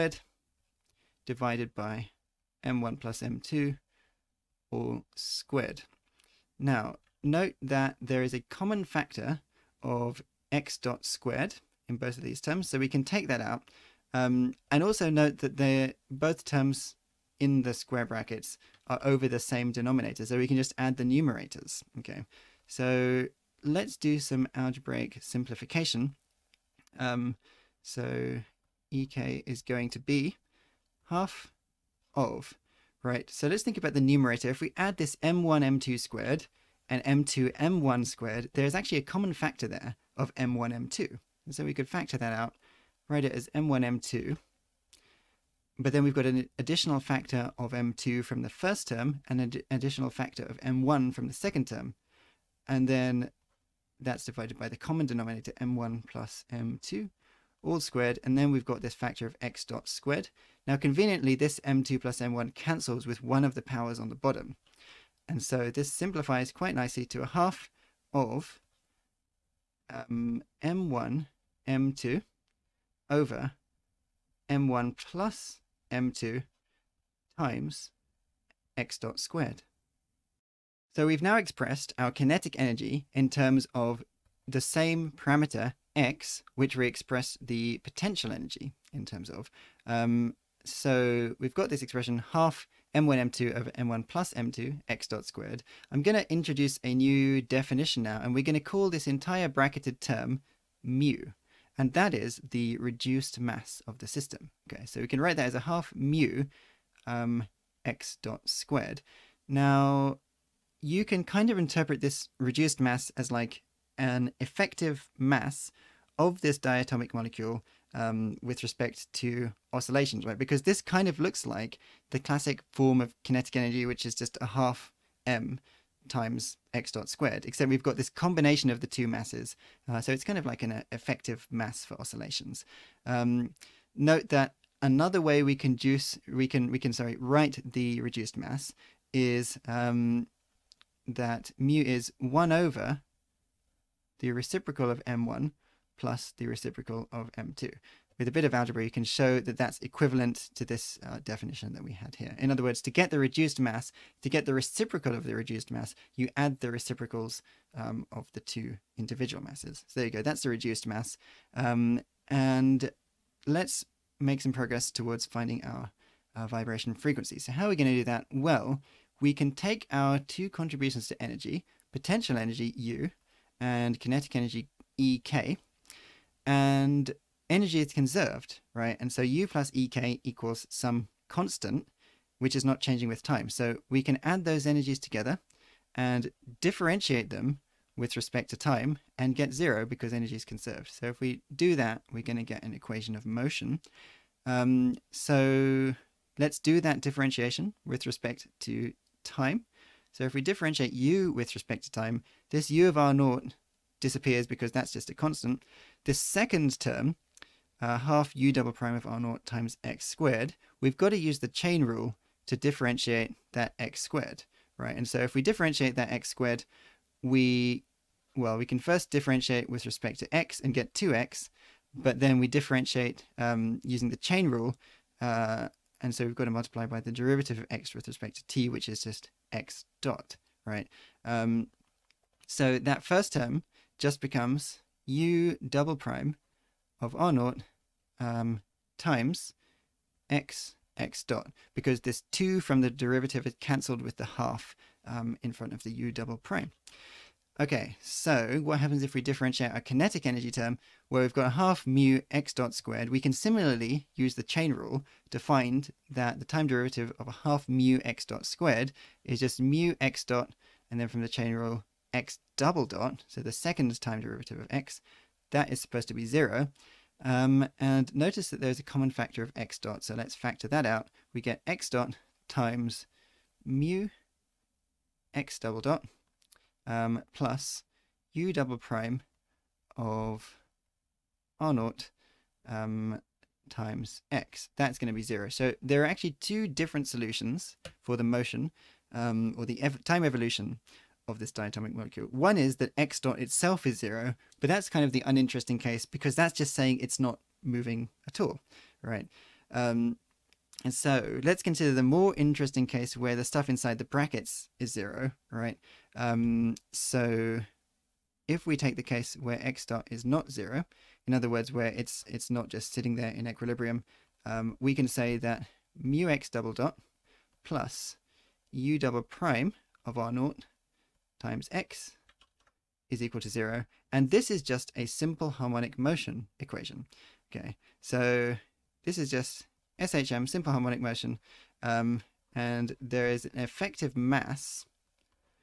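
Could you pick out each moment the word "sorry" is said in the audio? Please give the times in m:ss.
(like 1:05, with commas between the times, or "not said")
2:16.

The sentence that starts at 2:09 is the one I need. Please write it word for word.
Uh, so it's kind of like an uh, effective mass for oscillations.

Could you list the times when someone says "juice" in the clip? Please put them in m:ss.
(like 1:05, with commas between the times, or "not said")
2:15.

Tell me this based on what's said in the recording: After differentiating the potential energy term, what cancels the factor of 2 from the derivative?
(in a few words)
the half.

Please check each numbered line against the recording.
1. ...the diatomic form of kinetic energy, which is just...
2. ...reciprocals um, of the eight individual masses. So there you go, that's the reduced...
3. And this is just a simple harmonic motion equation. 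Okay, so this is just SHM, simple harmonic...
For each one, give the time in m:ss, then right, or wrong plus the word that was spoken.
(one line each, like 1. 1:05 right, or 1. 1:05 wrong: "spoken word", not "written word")
1. 2:02 wrong: "classic", not "diatomic"
2. 2:36 wrong: "two", not "eight"
3. 5:24 right.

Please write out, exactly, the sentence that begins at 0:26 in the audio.
Um, so ek is going to be half of, right?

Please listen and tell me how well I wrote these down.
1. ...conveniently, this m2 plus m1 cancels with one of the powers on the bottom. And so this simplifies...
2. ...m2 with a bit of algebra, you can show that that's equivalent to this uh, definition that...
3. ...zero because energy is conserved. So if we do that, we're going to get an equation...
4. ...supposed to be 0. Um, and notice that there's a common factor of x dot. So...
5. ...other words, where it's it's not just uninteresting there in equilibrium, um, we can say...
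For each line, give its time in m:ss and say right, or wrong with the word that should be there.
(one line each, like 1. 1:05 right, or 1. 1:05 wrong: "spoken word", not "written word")
1. 1:00 right
2. 2:27 right
3. 3:09 right
4. 4:25 right
5. 5:11 wrong: "sitting", not "uninteresting".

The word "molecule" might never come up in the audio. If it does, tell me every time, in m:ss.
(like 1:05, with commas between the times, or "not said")
1:57, 4:51.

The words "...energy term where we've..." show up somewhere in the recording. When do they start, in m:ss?
4:10.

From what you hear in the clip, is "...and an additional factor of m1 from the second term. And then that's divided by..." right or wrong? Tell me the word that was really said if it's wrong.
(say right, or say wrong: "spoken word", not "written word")
right.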